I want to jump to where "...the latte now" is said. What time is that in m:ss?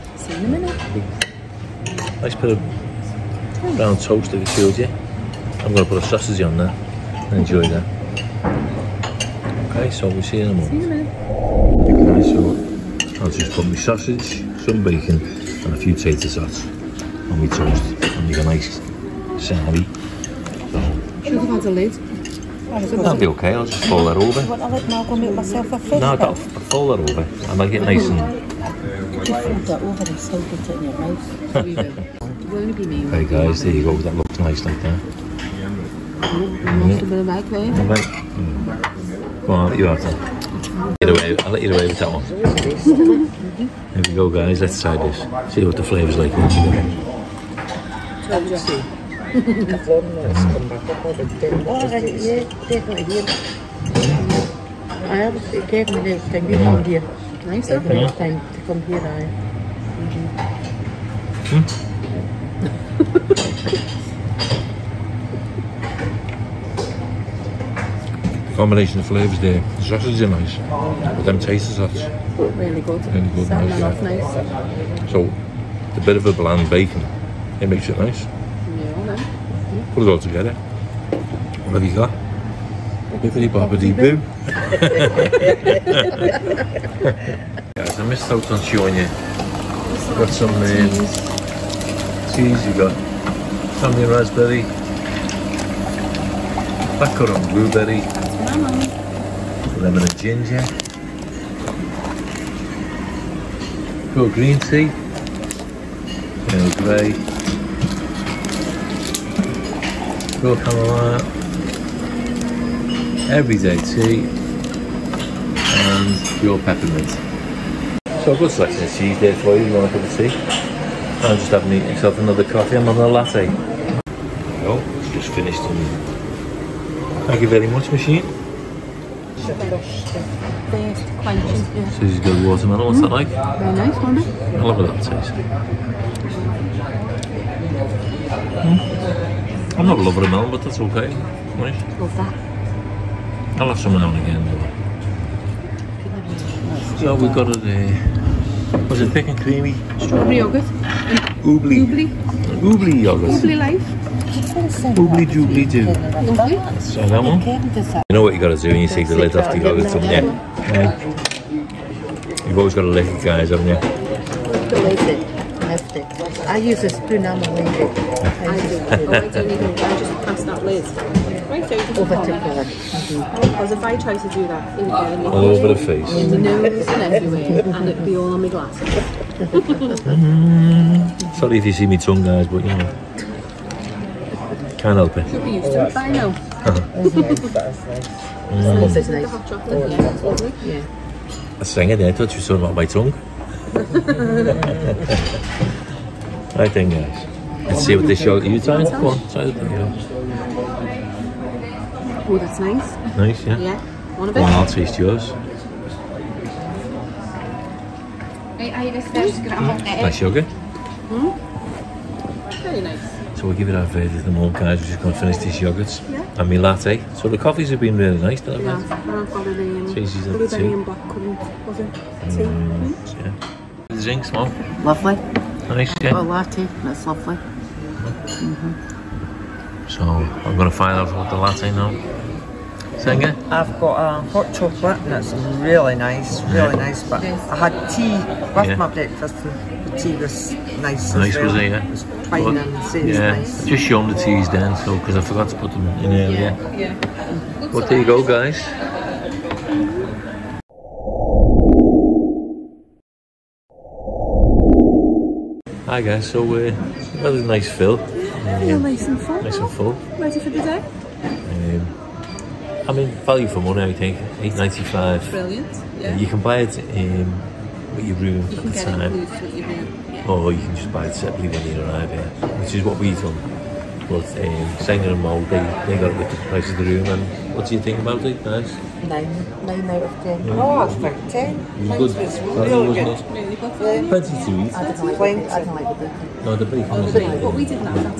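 3:51.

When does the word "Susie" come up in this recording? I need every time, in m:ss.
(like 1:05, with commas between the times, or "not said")
2:11.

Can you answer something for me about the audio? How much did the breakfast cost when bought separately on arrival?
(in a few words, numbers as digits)
8.95.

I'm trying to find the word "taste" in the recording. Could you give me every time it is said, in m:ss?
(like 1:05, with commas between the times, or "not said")
1:11, 2:14, 3:24.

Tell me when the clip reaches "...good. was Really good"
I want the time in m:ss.
4:42.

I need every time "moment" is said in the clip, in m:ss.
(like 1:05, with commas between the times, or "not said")
0:10, 3:34.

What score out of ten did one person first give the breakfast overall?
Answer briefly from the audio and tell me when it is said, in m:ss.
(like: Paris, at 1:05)
9, at 4:39.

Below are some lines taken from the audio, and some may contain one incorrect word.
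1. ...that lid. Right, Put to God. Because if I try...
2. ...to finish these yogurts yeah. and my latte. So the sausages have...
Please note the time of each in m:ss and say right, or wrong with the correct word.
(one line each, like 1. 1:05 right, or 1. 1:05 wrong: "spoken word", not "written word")
1. 2:50 wrong: "Over", not "Put"
2. 3:35 wrong: "coffees", not "sausages".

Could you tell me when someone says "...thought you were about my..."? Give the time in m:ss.
3:12.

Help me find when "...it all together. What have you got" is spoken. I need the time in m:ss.
1:20.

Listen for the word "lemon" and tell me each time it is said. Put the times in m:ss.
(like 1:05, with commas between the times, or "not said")
1:39.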